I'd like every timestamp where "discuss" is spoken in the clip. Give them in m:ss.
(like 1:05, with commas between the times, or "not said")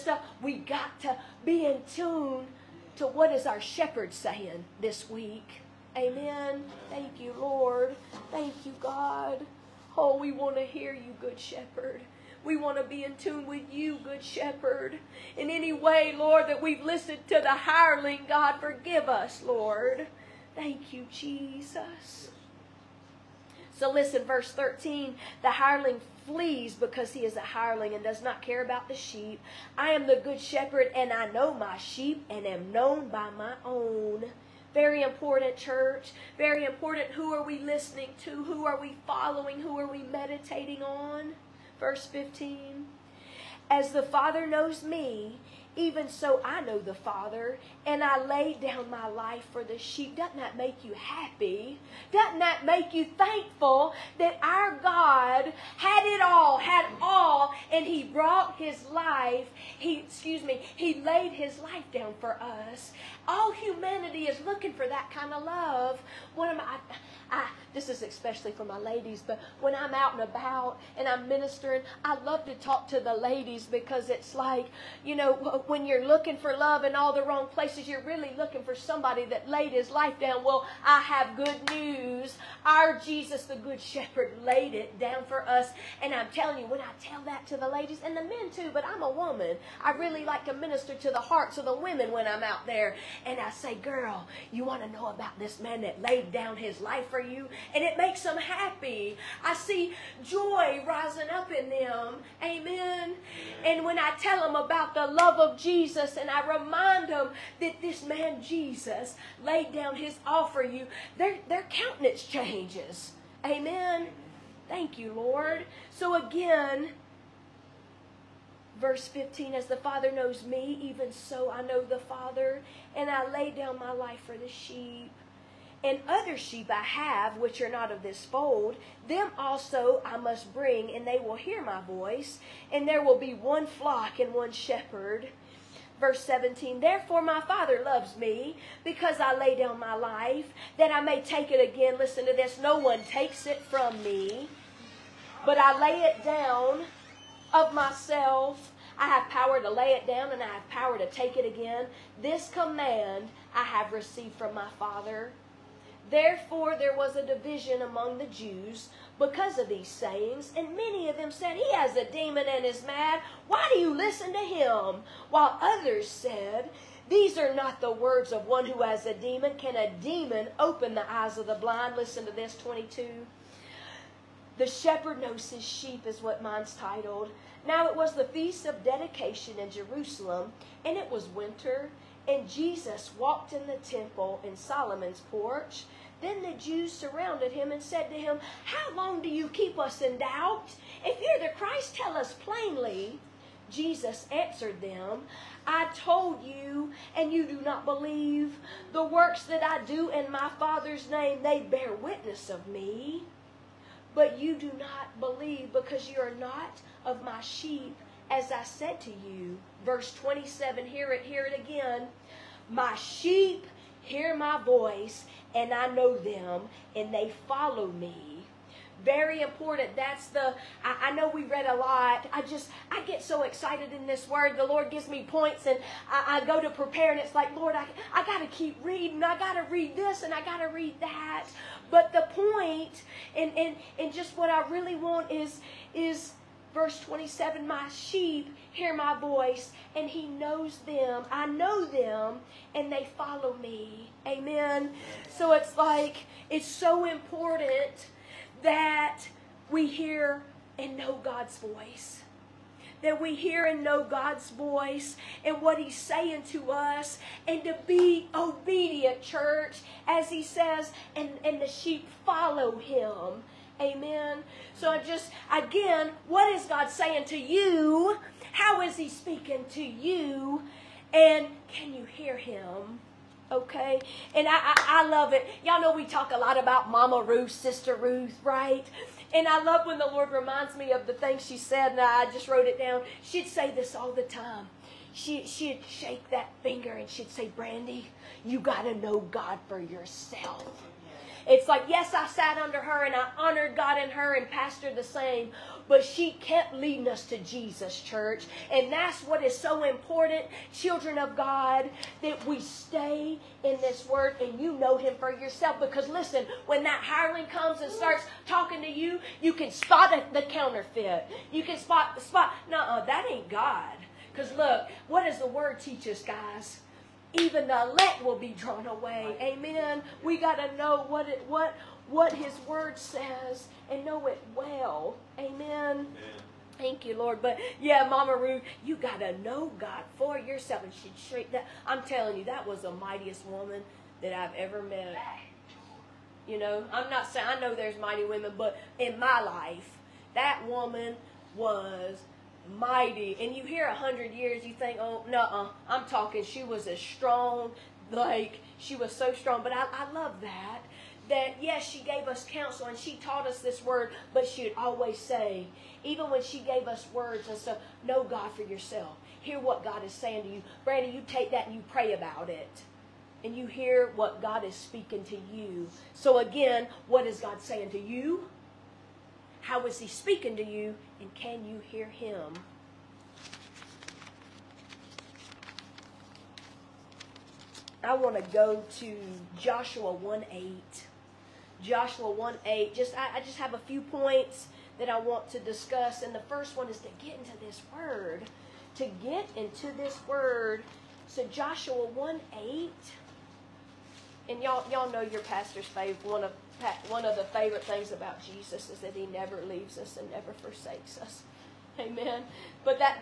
6:25.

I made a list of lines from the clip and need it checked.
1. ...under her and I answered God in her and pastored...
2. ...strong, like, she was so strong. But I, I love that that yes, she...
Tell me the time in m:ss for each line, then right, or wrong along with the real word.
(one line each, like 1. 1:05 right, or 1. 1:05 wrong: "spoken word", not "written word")
1. 4:52 wrong: "honored", not "answered"
2. 5:46 right.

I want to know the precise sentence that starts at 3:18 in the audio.
The works that I do in my Father's name, they bear witness of me.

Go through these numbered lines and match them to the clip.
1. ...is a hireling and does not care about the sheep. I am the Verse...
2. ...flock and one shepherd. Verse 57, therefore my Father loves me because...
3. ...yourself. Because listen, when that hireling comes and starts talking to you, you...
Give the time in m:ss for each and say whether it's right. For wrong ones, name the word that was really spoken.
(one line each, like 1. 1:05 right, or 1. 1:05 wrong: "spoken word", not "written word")
1. 0:27 wrong: "Good", not "Verse"
2. 2:13 wrong: "17", not "57"
3. 5:05 right.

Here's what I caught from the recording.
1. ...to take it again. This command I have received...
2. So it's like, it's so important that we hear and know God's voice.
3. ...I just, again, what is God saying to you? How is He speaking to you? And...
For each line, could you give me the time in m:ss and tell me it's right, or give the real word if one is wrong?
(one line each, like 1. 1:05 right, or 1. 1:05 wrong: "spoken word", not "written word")
1. 2:30 right
2. 4:05 right
3. 4:24 right.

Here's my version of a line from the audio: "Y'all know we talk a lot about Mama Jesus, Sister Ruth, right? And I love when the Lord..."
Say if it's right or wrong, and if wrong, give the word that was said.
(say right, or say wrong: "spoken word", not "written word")
wrong: "Ruth", not "Jesus".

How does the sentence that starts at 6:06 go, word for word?
So again, what is God saying to you?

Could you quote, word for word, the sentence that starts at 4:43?
She'd say this all the time.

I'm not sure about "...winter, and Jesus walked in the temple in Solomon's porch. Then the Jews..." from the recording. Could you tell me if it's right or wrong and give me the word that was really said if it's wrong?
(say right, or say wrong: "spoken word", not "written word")
right.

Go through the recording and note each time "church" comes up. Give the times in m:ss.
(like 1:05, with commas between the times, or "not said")
0:35, 4:19, 4:57.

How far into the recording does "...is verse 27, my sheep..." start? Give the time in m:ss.
3:55.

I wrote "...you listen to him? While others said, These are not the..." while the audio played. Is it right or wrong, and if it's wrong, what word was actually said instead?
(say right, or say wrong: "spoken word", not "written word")
right.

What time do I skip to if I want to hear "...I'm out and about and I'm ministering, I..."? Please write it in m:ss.
1:09.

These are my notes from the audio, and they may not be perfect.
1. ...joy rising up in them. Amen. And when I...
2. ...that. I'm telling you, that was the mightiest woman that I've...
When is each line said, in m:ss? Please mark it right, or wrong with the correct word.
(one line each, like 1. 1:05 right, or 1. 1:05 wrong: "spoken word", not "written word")
1. 1:40 right
2. 5:31 right.